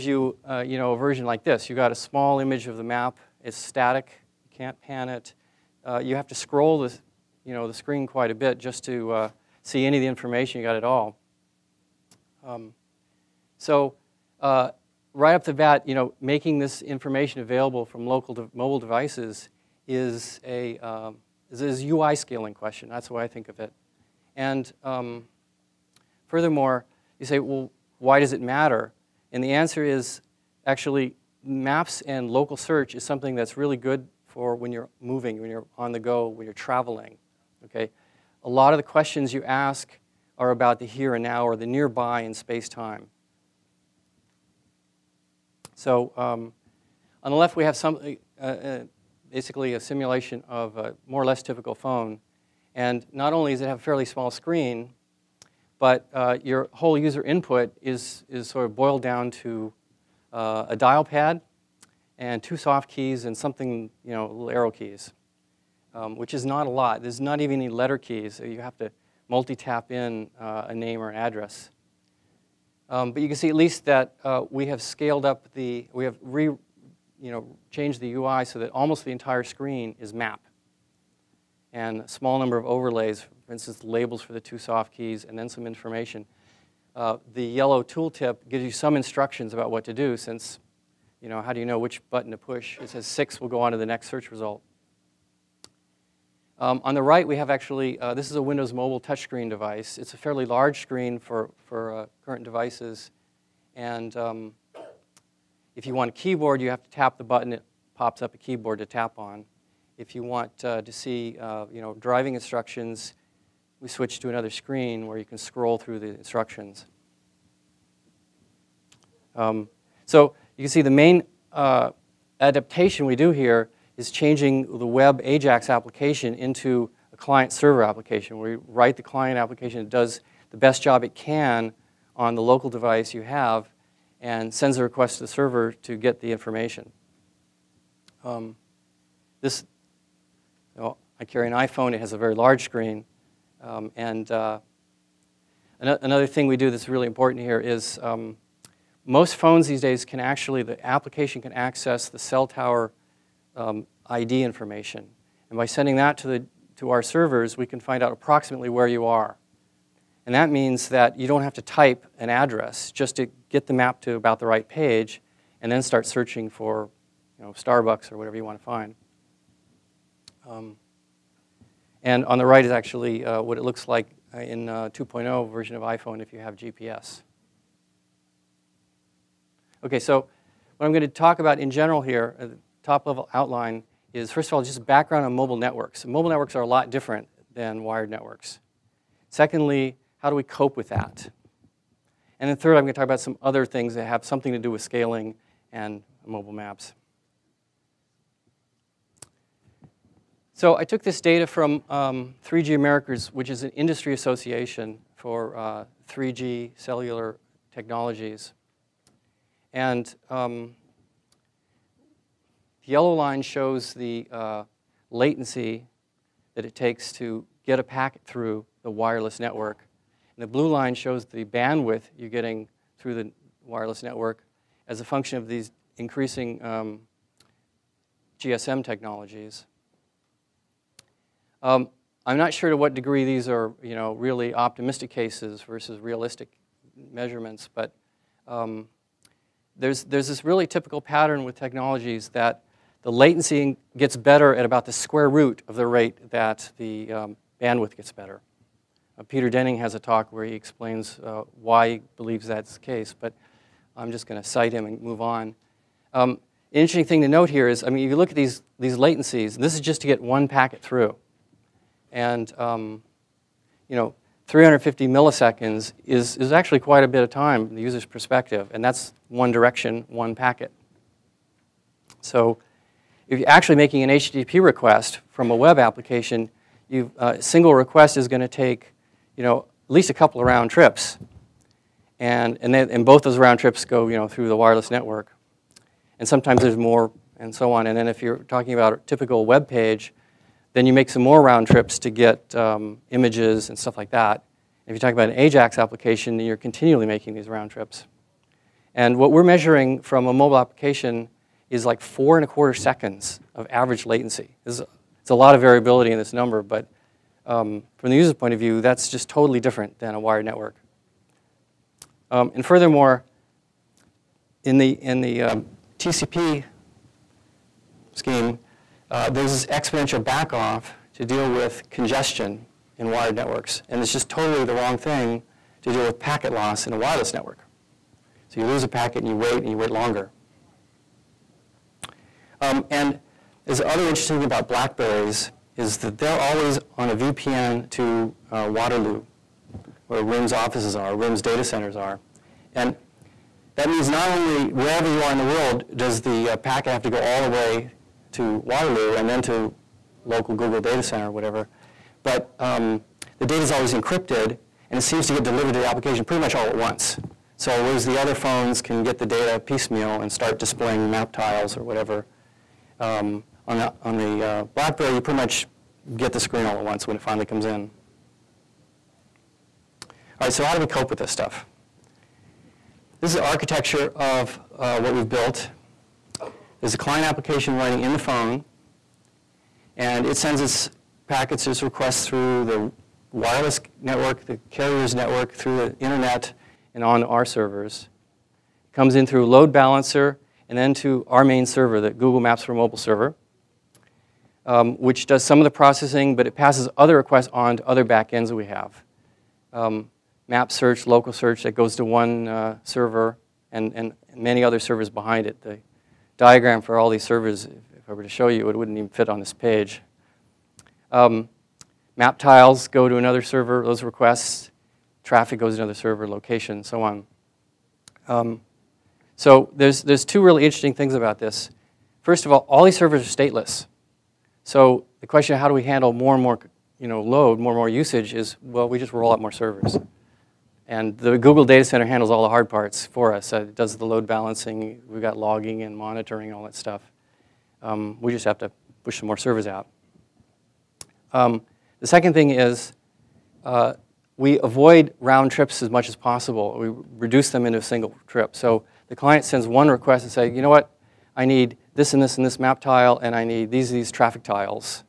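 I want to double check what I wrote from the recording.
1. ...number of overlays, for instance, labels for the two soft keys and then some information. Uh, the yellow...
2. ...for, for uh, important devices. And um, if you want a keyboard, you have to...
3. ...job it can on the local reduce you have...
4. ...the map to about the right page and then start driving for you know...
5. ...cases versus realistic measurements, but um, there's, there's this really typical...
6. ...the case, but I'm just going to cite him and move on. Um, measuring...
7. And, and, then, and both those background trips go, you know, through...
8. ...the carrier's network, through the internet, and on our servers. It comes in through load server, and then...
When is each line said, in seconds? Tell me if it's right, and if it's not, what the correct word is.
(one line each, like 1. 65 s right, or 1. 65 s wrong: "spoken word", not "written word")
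1. 82 s right
2. 101 s wrong: "current", not "important"
3. 130 s wrong: "device", not "reduce"
4. 163 s wrong: "searching", not "driving"
5. 235 s right
6. 252 s wrong: "interesting", not "measuring"
7. 282 s wrong: "round", not "background"
8. 384 s wrong: "balancer", not "server".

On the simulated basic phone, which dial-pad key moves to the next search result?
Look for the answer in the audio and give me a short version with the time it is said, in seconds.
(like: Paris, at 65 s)
6, at 93 s.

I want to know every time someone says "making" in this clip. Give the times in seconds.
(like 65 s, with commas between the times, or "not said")
16 s, 273 s, 297 s.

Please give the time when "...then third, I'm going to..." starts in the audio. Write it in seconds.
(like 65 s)
192 s.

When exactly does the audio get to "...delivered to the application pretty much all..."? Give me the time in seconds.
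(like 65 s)
355 s.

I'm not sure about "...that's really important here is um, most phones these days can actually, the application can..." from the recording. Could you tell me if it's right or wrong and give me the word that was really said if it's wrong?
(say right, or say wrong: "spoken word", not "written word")
right.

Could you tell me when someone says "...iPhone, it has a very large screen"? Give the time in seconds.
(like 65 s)
141 s.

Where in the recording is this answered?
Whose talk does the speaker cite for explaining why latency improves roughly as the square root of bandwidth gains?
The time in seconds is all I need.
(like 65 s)
249 s.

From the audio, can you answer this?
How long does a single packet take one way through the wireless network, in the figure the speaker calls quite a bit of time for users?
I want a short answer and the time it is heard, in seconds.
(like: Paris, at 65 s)
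350 milliseconds, at 264 s.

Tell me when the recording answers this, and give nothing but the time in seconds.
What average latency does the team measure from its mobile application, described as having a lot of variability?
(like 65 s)
302 s.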